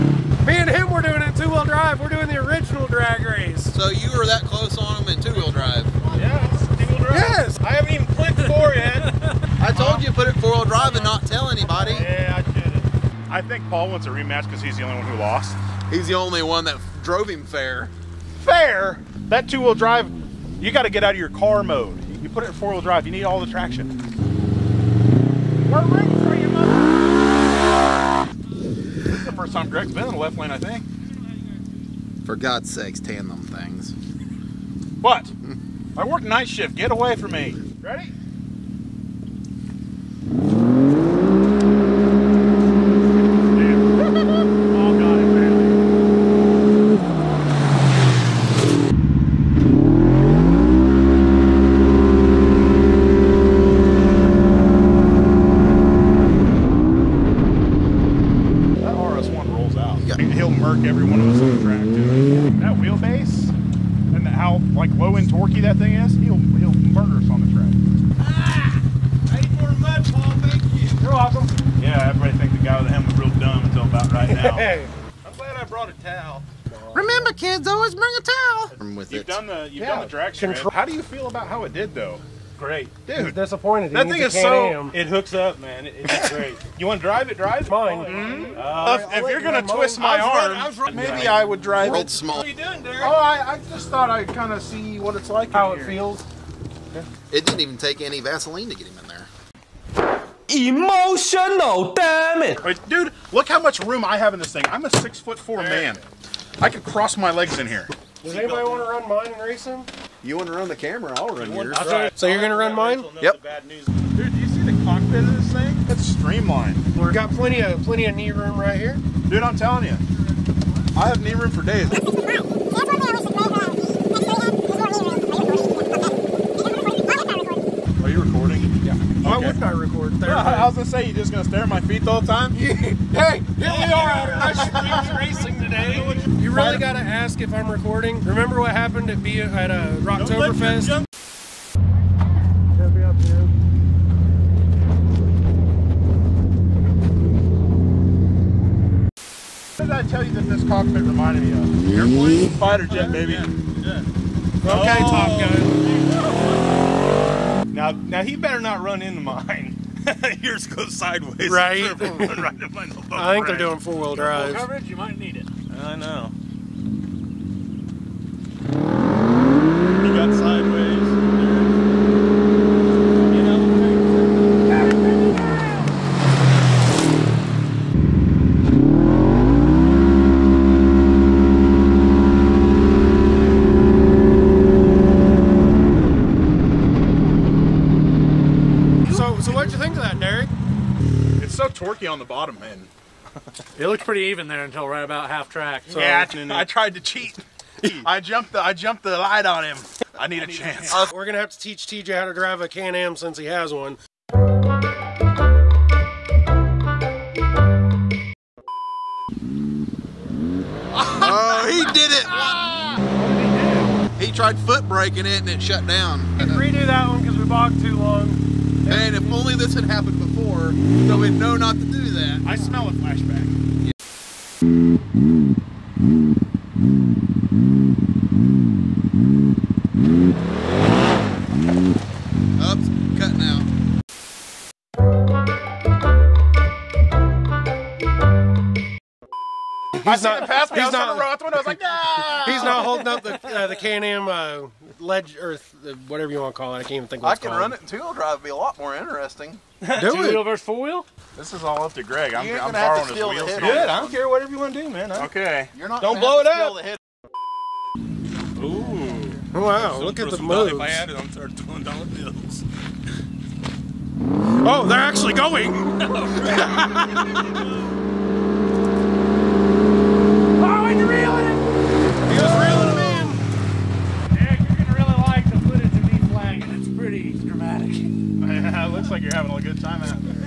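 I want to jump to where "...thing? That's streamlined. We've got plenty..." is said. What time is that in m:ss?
1:55.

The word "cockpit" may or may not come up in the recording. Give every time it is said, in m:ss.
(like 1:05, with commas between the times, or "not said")
1:54, 2:30.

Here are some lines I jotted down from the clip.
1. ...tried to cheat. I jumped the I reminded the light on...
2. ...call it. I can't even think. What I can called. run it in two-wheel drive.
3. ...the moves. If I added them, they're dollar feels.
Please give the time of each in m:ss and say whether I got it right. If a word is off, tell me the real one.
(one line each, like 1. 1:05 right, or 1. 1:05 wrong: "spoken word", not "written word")
1. 3:16 wrong: "jumped", not "reminded"
2. 4:06 right
3. 4:20 wrong: "bills", not "feels".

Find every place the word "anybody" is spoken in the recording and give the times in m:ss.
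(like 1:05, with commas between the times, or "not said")
0:11, 1:48.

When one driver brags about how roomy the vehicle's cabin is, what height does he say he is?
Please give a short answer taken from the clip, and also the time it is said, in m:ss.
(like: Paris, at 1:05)
6 foot 4, at 1:45.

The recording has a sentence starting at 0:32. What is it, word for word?
For God's sakes, tan them things.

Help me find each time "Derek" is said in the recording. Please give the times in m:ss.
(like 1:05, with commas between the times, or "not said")
1:32, 3:10.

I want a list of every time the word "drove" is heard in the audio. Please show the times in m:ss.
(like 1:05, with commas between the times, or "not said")
0:17.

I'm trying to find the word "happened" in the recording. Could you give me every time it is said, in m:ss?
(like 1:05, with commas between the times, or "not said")
2:18, 3:39.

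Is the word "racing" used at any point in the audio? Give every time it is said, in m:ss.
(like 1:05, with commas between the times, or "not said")
2:15.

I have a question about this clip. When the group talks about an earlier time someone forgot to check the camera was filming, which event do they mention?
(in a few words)
Rocktoberfest.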